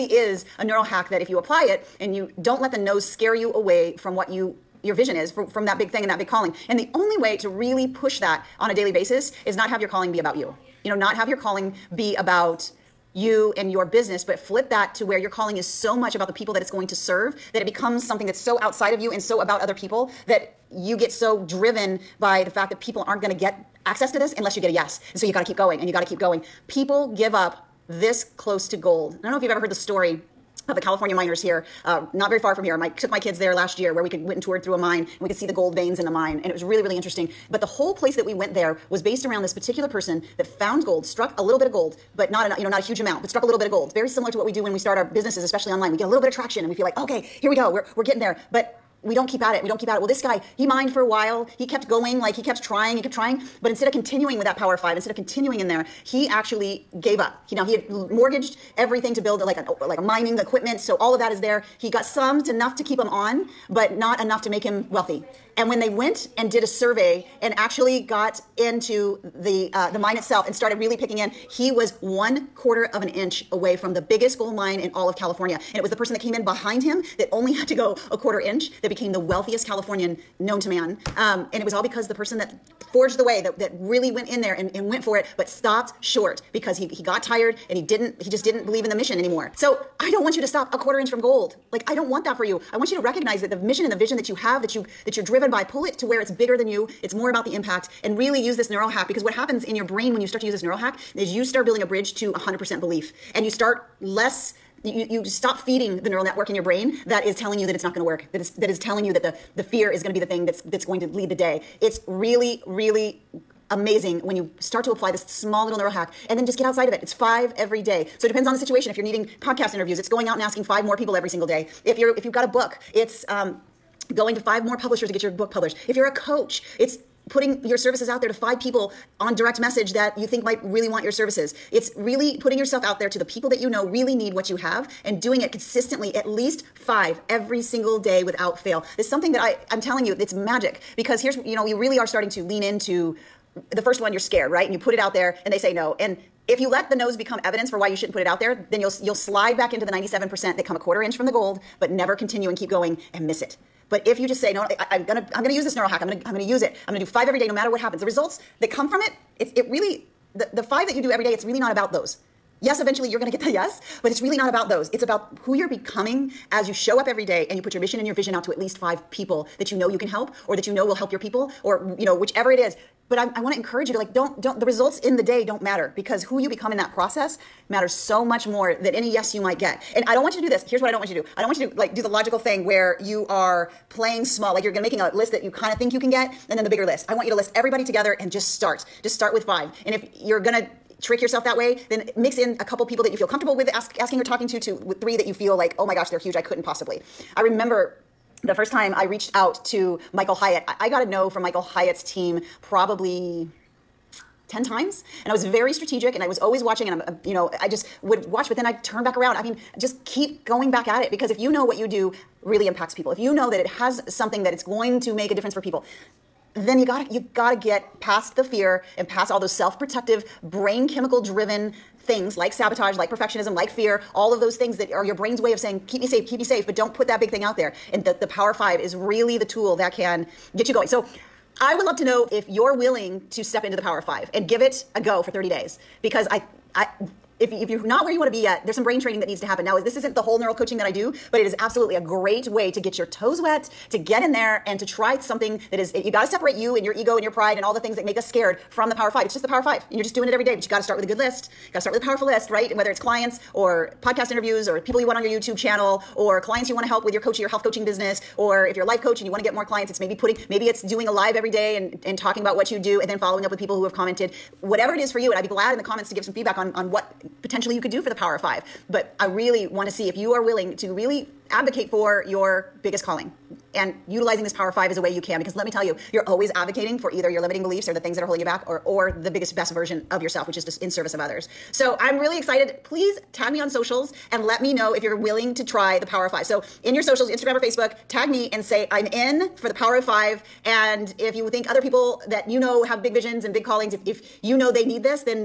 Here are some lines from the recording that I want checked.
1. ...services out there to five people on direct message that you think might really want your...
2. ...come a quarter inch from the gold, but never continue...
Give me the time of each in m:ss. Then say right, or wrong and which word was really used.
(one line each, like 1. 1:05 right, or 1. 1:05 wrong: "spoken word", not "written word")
1. 2:07 right
2. 2:30 right.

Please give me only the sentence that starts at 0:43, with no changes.
Very similar to what we do when we start our businesses, especially online.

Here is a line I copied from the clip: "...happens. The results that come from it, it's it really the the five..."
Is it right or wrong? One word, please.
right.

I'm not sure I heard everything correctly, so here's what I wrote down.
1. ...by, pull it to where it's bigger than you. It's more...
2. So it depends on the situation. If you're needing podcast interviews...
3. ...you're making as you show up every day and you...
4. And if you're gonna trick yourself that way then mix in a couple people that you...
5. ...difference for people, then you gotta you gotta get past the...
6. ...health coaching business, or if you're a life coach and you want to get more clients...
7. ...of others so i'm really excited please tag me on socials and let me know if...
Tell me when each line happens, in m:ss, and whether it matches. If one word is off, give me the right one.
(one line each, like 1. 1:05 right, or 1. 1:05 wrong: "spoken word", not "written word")
1. 1:35 right
2. 1:58 right
3. 2:45 wrong: "becoming", not "making"
4. 3:09 right
5. 3:35 right
6. 4:17 right
7. 4:41 right.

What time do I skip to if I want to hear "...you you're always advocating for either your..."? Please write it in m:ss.
4:35.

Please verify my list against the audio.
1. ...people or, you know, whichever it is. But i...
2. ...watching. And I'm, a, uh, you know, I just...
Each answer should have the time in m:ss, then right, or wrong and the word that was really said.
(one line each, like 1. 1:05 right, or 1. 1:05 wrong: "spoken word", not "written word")
1. 2:51 right
2. 3:26 right.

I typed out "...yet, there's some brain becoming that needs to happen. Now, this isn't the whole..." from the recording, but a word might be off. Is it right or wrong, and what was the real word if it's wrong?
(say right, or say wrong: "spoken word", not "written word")
wrong: "training", not "becoming".